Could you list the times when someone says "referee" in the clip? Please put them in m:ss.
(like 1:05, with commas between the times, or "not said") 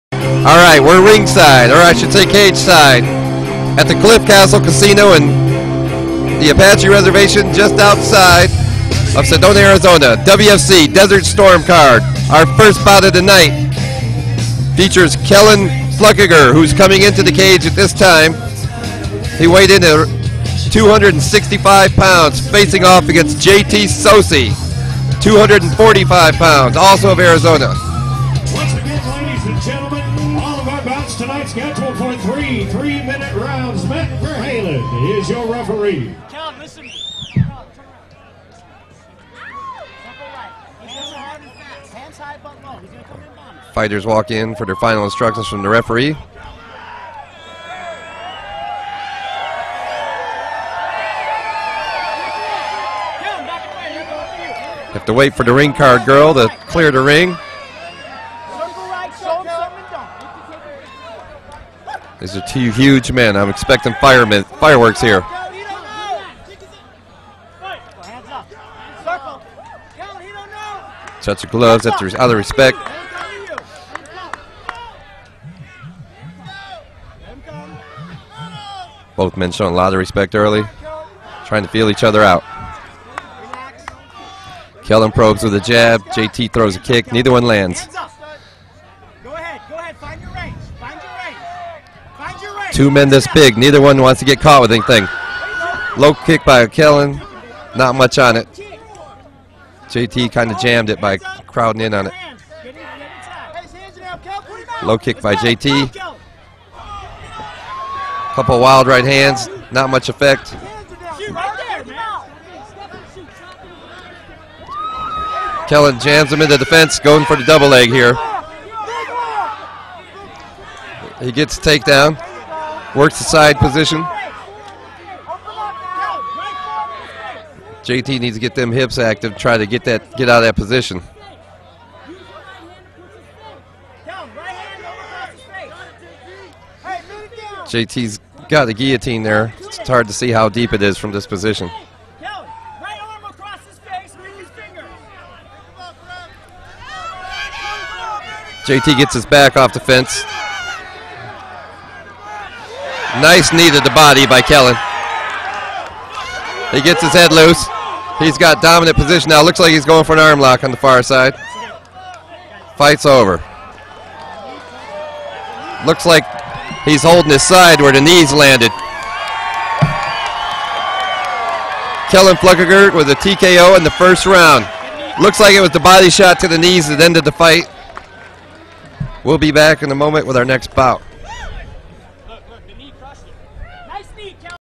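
0:35, 0:45.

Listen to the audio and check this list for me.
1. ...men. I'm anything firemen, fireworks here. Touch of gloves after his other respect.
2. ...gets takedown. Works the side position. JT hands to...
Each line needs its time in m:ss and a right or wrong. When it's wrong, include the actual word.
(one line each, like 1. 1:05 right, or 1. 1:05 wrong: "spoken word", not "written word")
1. 1:03 wrong: "expecting", not "anything"
2. 2:01 wrong: "needs", not "hands".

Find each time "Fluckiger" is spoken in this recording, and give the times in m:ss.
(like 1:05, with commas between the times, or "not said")
0:16, 2:52.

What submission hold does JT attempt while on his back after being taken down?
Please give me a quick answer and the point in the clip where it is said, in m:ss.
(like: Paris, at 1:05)
guillotine, at 2:18.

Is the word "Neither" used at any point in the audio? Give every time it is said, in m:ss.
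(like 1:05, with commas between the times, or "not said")
1:27, 1:33.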